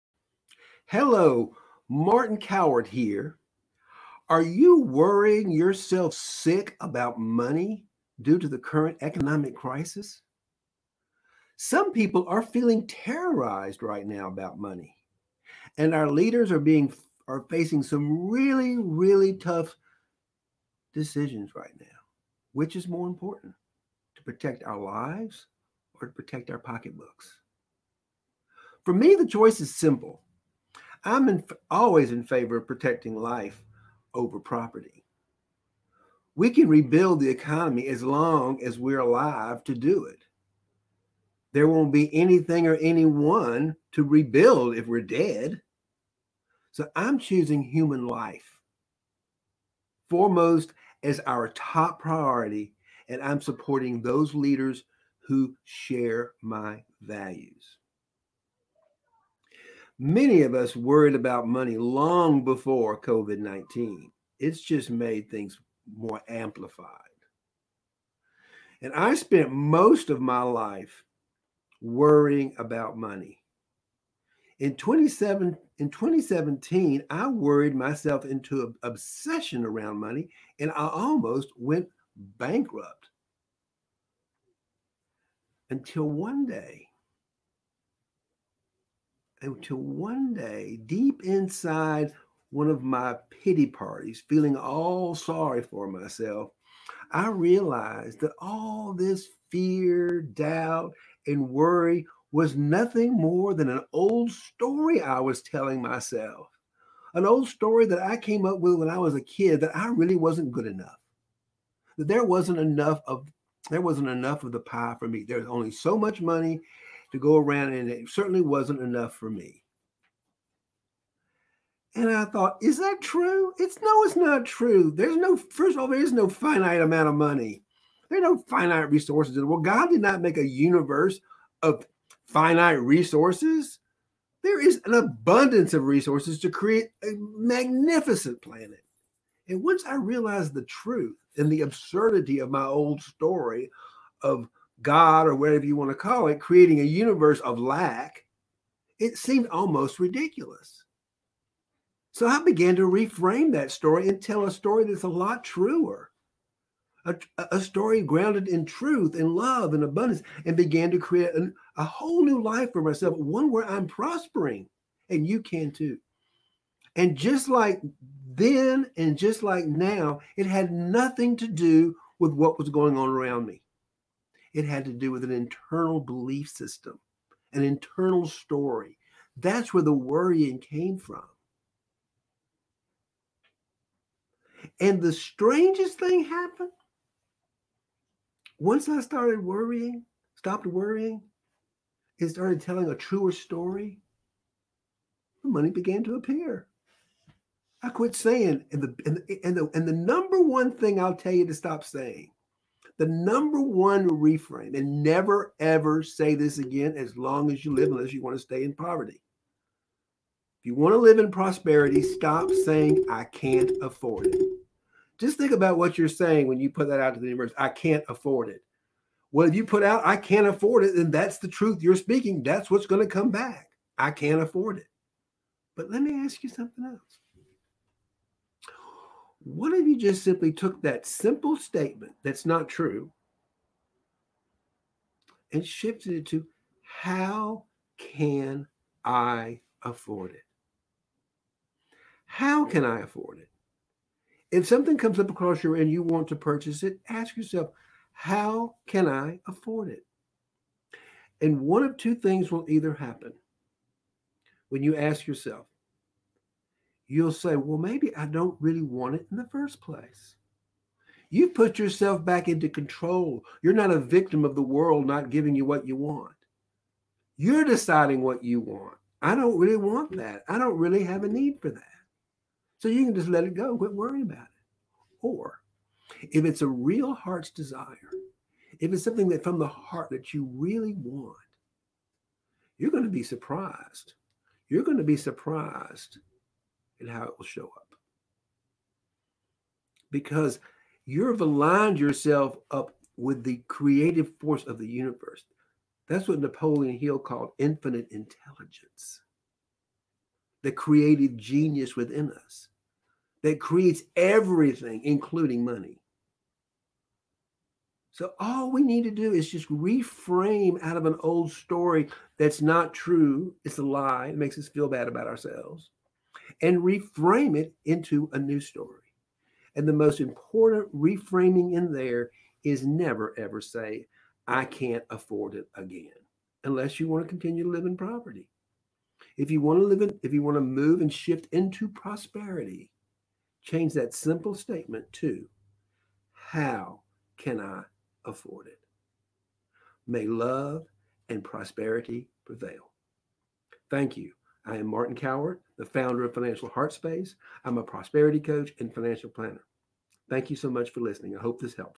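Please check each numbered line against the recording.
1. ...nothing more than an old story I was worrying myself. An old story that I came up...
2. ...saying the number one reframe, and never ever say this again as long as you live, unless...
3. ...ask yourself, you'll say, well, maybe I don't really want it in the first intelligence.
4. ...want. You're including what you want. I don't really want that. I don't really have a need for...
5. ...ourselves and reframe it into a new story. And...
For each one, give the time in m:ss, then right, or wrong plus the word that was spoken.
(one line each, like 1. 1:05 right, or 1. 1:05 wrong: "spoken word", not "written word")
1. 1:42 wrong: "telling", not "worrying"
2. 3:21 right
3. 4:14 wrong: "place", not "intelligence"
4. 4:25 wrong: "deciding", not "including"
5. 5:15 right.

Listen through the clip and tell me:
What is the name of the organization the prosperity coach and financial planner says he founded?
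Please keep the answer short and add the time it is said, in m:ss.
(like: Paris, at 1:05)
Financial Heart Space, at 5:46.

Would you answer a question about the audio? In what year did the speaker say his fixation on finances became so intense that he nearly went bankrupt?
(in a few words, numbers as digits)
2017.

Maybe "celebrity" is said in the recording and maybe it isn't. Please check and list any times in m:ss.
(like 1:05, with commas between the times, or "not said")
not said.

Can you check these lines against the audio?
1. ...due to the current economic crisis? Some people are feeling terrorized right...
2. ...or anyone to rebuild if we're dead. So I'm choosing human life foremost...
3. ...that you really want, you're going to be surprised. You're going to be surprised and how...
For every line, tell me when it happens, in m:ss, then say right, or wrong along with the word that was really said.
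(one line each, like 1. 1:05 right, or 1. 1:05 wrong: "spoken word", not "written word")
1. 0:08 right
2. 0:42 right
3. 4:40 right.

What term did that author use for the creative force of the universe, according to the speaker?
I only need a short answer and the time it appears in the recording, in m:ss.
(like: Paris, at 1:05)
infinite intelligence, at 4:57.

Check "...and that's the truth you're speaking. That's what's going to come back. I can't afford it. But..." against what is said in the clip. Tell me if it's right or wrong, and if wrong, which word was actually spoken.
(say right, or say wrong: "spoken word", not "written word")
right.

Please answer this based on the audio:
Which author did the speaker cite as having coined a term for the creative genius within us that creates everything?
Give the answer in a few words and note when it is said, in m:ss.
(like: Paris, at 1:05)
Napoleon Hill, at 4:56.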